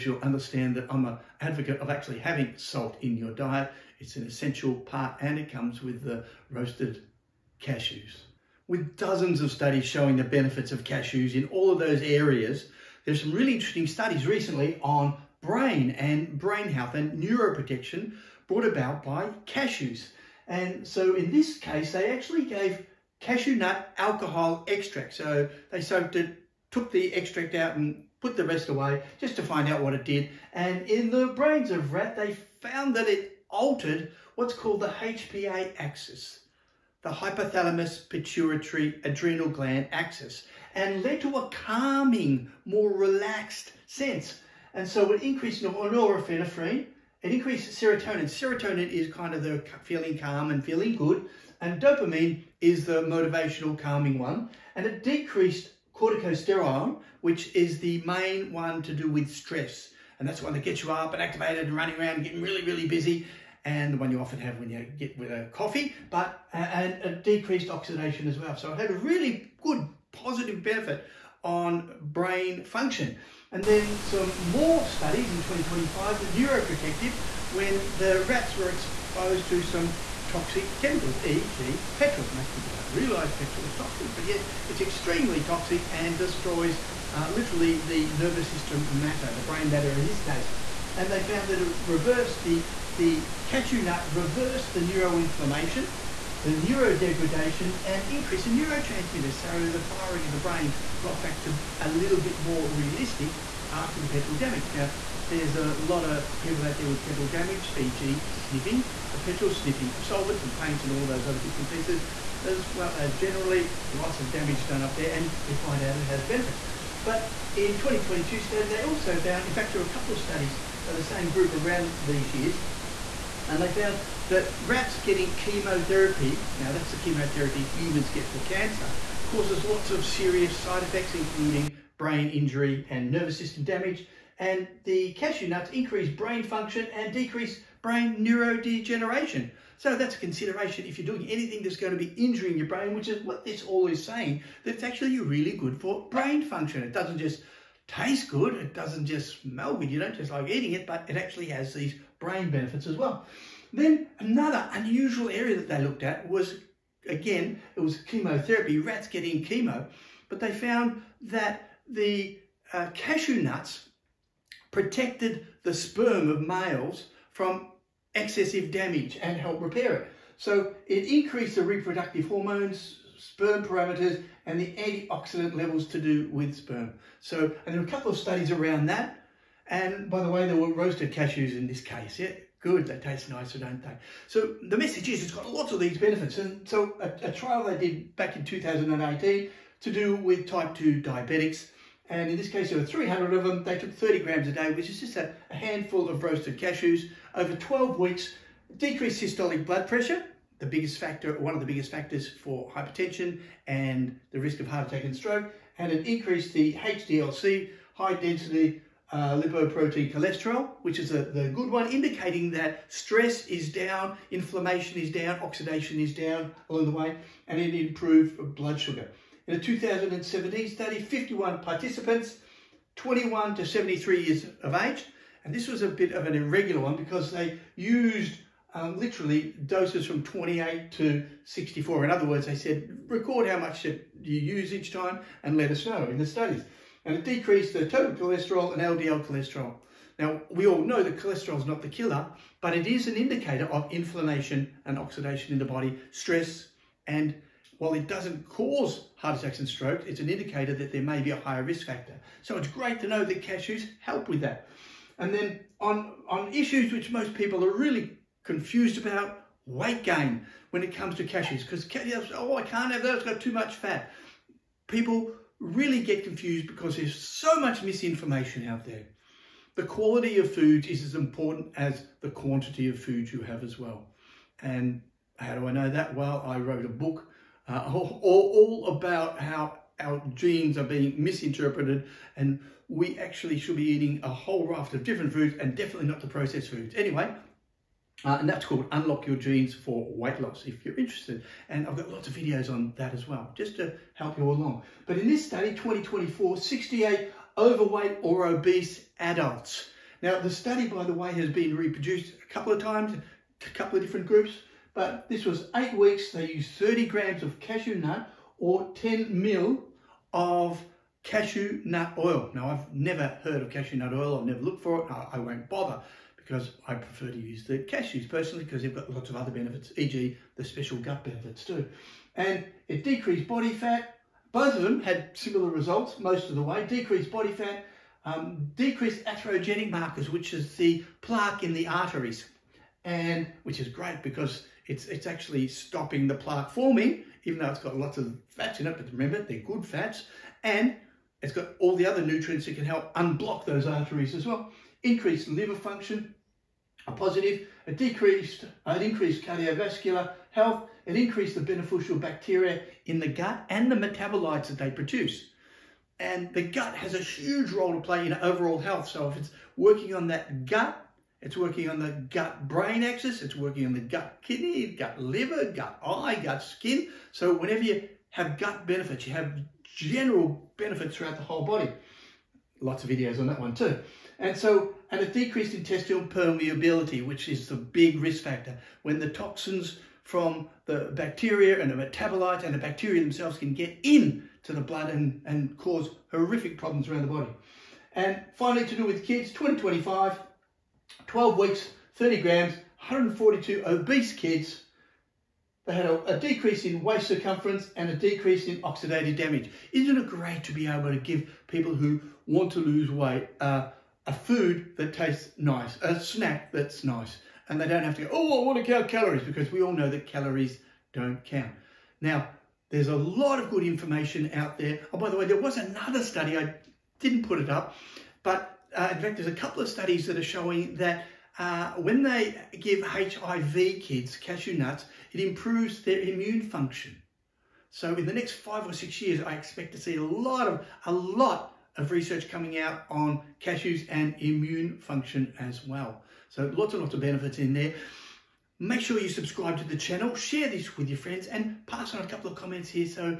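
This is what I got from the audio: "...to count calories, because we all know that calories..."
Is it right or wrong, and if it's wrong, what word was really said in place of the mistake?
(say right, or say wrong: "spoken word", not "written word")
right.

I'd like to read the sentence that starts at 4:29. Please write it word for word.
The quality of foods is as important as the quantity of food you have as well.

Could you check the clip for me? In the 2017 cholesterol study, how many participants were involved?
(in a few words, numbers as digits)
51.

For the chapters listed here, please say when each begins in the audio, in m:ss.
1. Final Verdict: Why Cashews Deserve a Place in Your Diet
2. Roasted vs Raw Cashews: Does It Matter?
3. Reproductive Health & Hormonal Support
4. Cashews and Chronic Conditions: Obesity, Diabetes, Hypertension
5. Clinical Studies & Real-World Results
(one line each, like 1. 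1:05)
1. 6:12
2. 3:42
3. 2:12
4. 0:12
5. 4:42.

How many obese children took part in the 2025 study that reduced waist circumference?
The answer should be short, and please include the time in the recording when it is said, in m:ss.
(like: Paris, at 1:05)
142, at 6:32.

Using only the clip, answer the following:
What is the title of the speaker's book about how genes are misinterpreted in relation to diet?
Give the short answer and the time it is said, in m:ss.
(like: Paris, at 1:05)
Unlock Your Genes for Weight Loss, at 4:48.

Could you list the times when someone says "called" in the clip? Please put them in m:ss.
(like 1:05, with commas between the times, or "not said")
0:34, 4:48.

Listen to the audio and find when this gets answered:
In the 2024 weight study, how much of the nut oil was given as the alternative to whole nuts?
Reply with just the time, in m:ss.
5:08.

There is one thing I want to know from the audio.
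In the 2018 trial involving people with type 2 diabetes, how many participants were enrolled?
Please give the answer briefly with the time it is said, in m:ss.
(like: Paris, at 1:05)
300, at 3:12.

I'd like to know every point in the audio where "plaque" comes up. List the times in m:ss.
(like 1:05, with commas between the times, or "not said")
5:31, 5:36.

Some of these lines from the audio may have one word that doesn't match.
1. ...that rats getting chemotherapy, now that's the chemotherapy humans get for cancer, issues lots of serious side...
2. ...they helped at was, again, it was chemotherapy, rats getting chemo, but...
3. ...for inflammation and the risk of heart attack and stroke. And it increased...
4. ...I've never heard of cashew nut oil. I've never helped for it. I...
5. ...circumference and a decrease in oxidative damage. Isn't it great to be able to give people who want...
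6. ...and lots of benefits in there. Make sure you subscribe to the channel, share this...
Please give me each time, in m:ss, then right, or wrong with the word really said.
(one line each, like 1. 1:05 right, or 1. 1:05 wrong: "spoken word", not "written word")
1. 2:04 wrong: "causes", not "issues"
2. 2:35 wrong: "looked", not "helped"
3. 3:22 wrong: "hypertension", not "inflammation"
4. 5:12 wrong: "looked", not "helped"
5. 6:37 right
6. 7:16 right.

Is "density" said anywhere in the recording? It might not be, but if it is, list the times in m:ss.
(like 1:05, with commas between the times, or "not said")
3:28.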